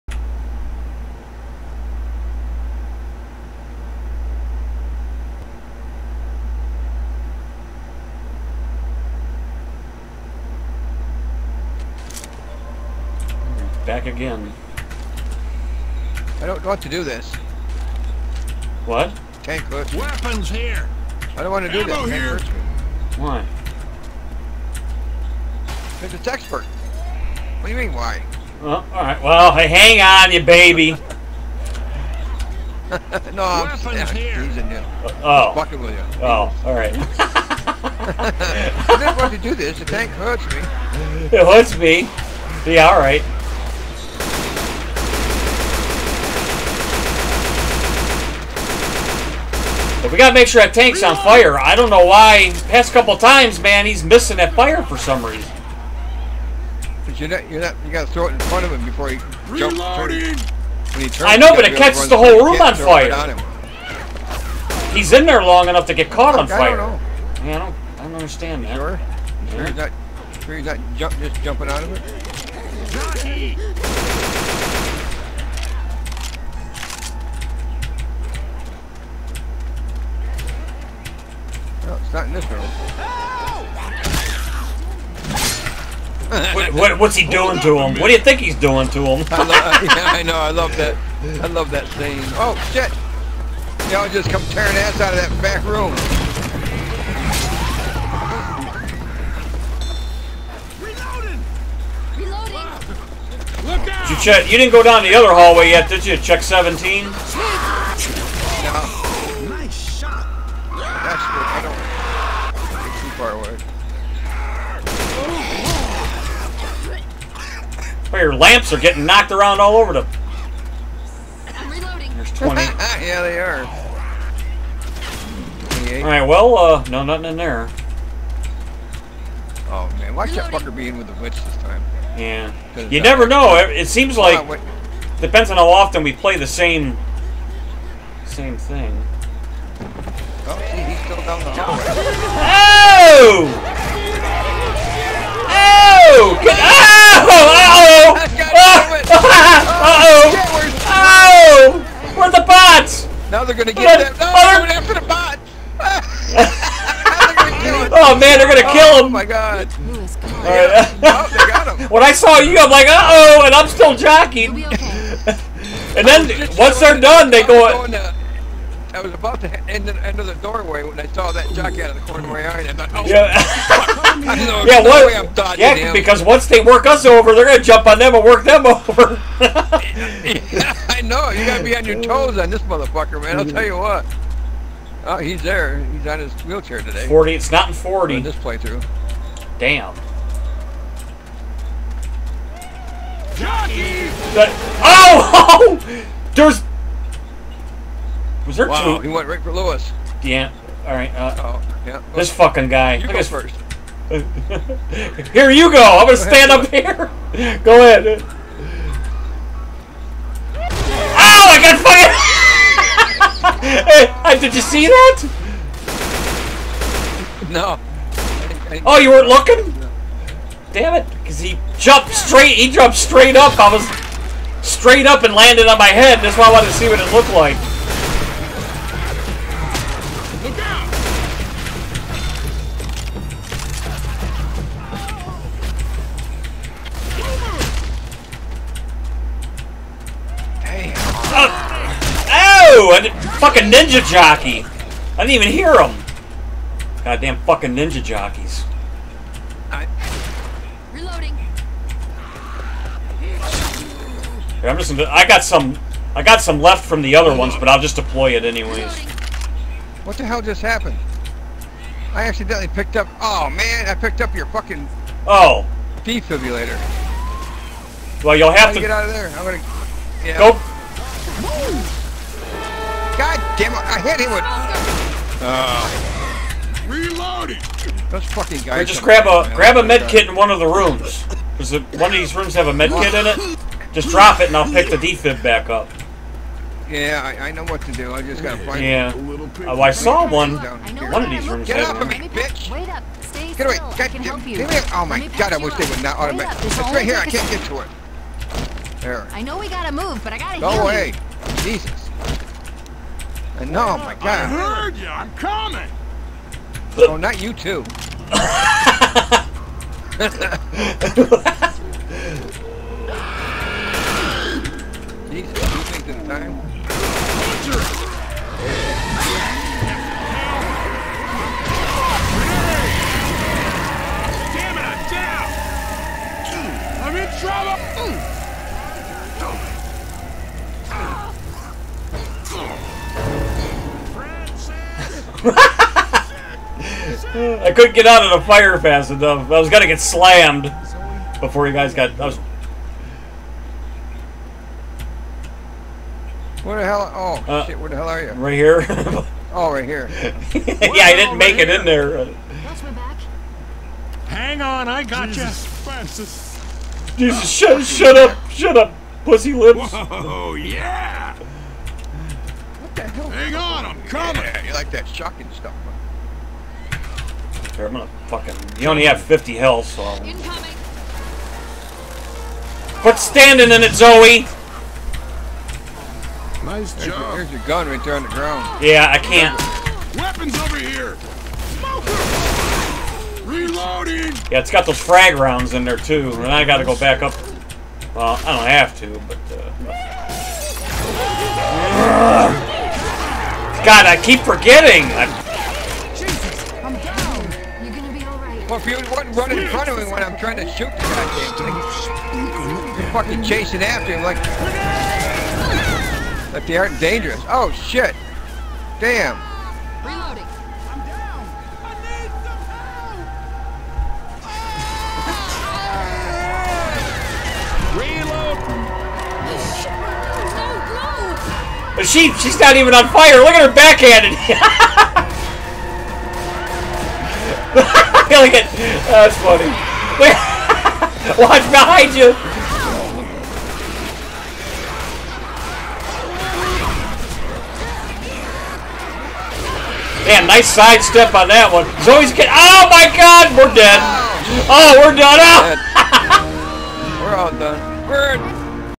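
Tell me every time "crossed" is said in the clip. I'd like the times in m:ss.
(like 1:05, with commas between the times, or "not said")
not said.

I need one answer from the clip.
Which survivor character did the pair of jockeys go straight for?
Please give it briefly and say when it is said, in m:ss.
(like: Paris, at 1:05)
Louis, at 3:19.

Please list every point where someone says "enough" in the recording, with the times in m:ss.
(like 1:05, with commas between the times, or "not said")
1:05, 5:39.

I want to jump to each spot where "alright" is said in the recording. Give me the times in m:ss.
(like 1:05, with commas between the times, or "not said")
0:28, 0:36, 0:42, 2:06.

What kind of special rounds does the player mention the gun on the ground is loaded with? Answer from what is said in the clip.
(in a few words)
Frag rounds.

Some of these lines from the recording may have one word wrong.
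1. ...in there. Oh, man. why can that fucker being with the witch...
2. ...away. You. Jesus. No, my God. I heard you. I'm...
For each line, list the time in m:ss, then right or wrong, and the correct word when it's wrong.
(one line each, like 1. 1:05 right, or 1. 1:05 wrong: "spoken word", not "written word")
1. 2:07 right
2. 5:00 right.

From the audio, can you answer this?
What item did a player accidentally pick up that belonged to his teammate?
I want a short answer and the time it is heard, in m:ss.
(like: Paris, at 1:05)
Defibrillator, at 4:26.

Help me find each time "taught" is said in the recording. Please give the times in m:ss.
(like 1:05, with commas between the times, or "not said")
not said.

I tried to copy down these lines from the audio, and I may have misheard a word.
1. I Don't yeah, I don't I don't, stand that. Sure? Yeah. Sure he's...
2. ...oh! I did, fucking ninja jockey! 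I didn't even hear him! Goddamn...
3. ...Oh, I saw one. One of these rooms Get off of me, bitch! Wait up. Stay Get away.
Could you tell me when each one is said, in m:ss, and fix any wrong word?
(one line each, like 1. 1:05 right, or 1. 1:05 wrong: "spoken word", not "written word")
1. 1:06 wrong: "understand", not "stand"
2. 4:02 right
3. 4:49 right.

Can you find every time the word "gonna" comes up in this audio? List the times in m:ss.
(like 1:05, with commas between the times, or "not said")
2:33, 2:38, 2:57, 3:26, 4:29, 5:39, 6:07.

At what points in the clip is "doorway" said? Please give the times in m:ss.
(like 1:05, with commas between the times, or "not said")
2:50.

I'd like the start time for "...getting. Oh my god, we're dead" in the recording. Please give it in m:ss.
7:22.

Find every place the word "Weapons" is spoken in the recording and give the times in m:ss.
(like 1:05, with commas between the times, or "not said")
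0:19, 6:20.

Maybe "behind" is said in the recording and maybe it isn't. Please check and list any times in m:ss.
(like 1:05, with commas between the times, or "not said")
7:11.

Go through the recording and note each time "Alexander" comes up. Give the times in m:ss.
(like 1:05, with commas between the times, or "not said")
not said.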